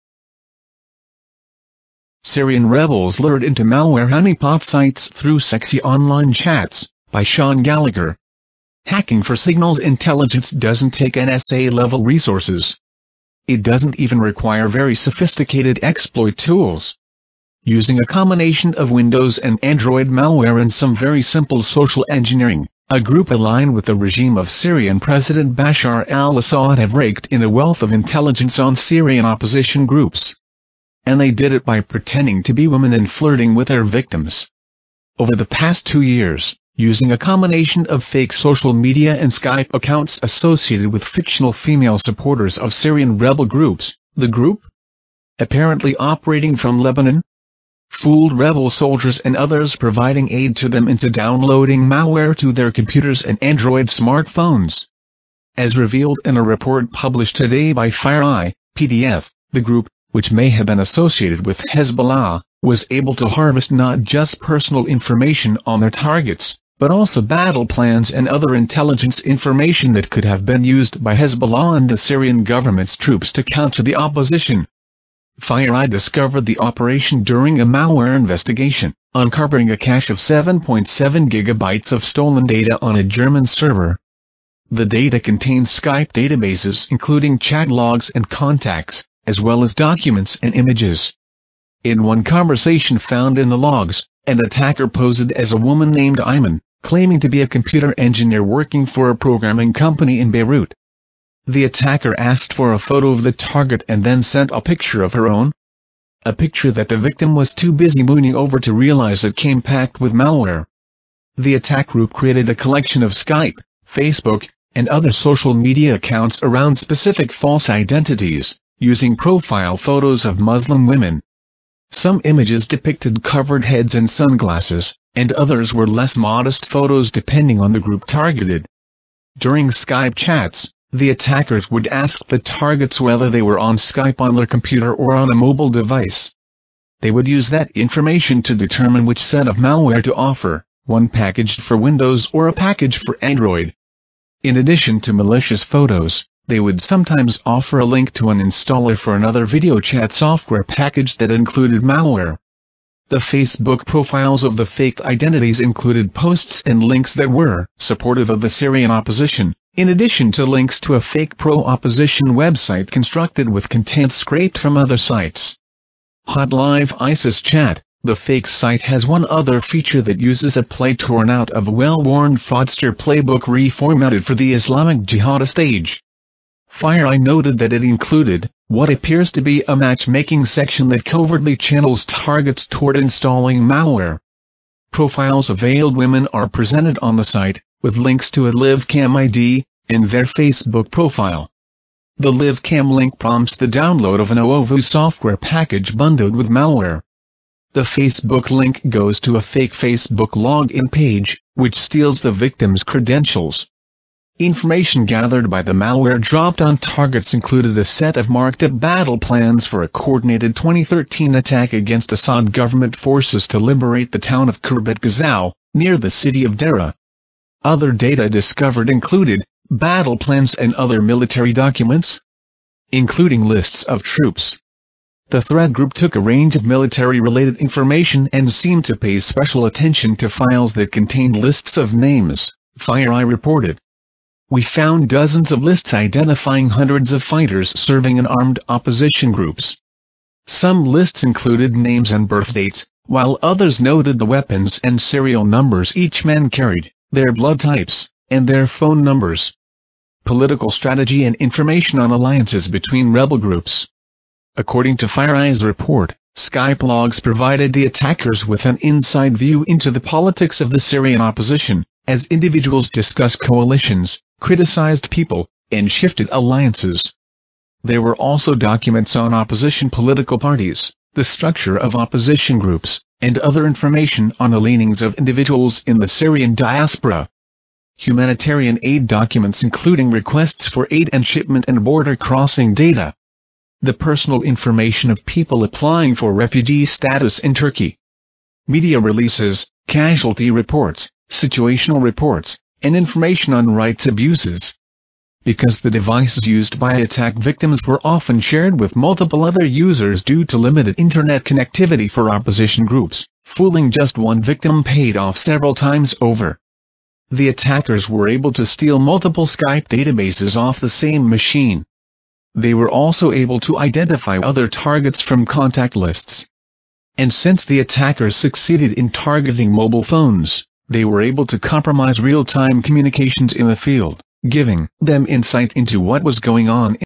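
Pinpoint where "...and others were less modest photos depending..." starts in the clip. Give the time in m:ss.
2:05.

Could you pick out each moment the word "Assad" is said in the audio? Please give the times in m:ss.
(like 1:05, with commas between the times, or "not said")
0:26, 3:32.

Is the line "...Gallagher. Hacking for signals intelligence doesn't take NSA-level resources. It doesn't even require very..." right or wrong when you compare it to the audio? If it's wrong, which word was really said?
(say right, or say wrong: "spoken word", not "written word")
right.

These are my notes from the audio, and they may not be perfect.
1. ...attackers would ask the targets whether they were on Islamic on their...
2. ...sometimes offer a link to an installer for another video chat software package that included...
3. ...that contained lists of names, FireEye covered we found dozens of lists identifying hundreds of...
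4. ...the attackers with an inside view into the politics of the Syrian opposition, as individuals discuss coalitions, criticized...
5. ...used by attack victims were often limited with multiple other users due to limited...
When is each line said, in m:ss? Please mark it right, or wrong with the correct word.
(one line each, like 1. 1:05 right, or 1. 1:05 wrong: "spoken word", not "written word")
1. 2:11 wrong: "Skype", not "Islamic"
2. 2:26 right
3. 3:50 wrong: "reported", not "covered"
4. 4:17 right
5. 4:56 wrong: "shared", not "limited".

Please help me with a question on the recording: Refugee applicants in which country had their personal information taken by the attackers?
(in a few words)
Turkey.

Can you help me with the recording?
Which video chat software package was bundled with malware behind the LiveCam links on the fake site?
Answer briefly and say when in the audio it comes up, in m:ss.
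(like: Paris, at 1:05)
ooVoo, at 3:14.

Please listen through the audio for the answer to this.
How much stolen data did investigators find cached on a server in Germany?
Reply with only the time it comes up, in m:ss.
1:20.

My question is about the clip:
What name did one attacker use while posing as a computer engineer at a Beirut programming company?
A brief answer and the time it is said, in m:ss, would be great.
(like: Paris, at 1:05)
Iman, at 1:36.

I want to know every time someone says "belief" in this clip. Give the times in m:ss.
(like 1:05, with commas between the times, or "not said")
not said.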